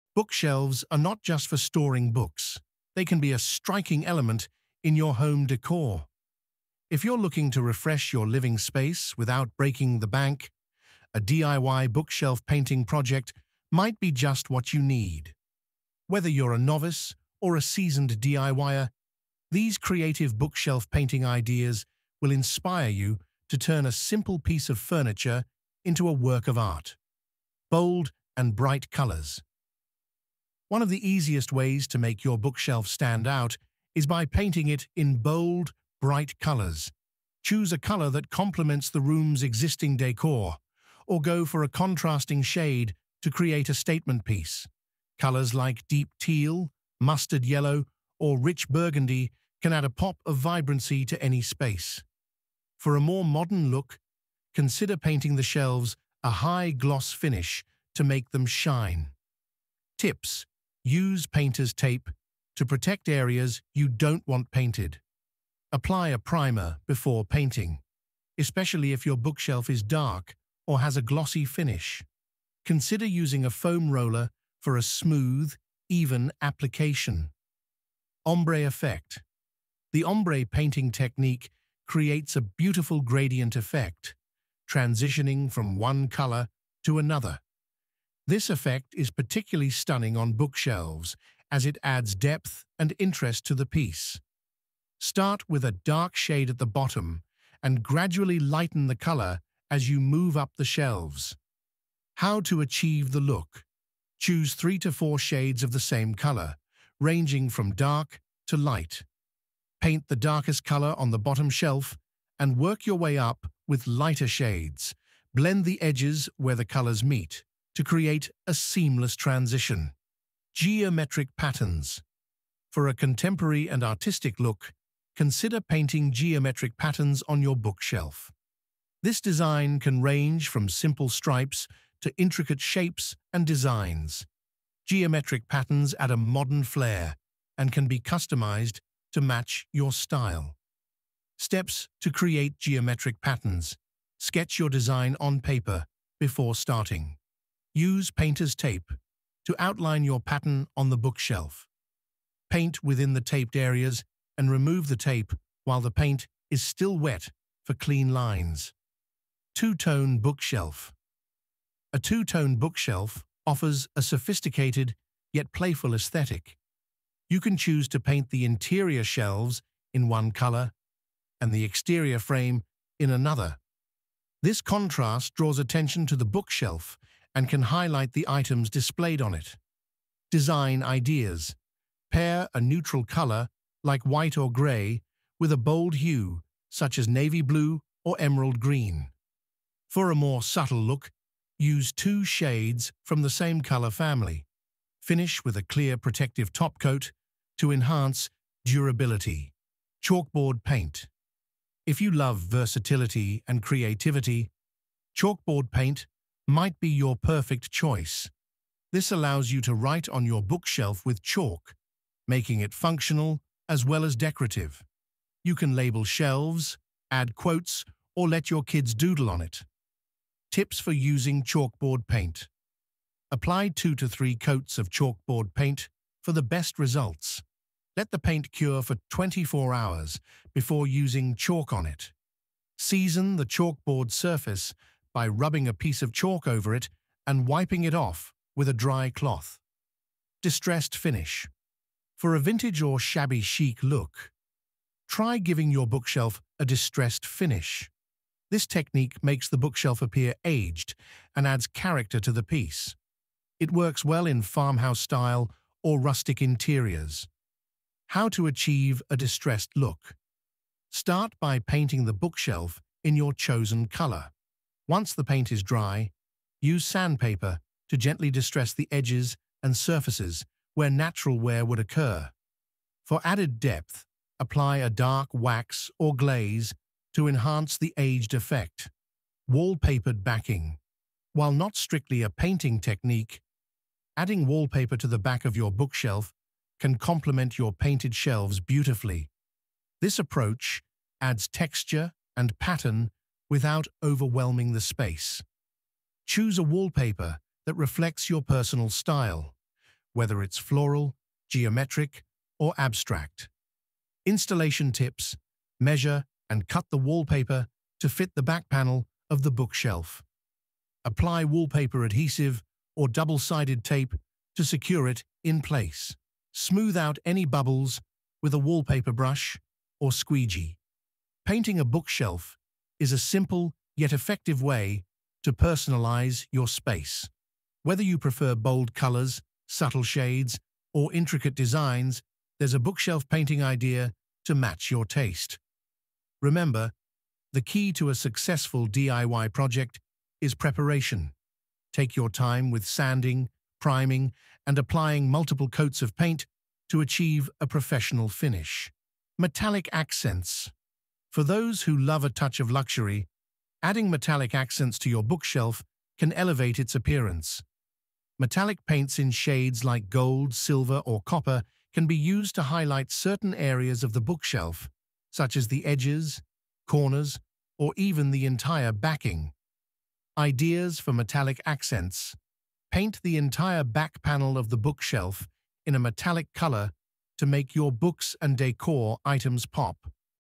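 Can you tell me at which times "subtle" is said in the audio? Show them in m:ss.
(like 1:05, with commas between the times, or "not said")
3:10, 5:29.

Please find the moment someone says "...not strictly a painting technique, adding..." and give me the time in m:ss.
4:41.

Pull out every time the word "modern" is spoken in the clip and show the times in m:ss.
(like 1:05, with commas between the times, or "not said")
0:53, 2:16.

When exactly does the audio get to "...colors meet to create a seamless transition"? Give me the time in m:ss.
1:56.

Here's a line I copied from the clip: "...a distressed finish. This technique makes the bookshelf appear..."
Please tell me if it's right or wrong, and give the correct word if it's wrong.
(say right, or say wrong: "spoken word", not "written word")
right.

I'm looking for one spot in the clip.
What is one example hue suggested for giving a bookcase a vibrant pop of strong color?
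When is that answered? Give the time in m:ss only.
0:47.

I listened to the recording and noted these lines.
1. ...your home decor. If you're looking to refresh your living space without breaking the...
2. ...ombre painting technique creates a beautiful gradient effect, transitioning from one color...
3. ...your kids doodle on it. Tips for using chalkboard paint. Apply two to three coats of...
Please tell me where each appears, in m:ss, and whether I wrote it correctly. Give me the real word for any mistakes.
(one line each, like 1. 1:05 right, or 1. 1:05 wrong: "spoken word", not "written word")
1. 0:04 right
2. 1:20 right
3. 3:38 right.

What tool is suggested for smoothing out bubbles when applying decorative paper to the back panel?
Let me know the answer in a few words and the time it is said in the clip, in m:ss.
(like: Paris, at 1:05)
Squeegee, at 5:20.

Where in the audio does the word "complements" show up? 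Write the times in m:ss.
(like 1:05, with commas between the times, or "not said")
0:38, 4:46.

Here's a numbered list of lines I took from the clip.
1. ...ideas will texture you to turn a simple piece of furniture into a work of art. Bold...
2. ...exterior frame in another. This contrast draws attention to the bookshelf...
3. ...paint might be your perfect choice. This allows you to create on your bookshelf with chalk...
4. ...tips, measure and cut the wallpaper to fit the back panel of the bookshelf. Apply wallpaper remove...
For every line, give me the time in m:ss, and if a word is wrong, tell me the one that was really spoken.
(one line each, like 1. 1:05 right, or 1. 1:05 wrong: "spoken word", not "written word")
1. 0:21 wrong: "inspire", not "texture"
2. 2:51 right
3. 3:25 wrong: "write", not "create"
4. 5:04 wrong: "adhesive", not "remove".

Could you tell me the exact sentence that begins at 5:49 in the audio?
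Metallic accents for those who love a touch of luxury, adding metallic accents to your bookshelf can elevate its appearance.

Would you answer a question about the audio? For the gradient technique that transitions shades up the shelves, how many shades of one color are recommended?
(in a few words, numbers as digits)
3 to 4.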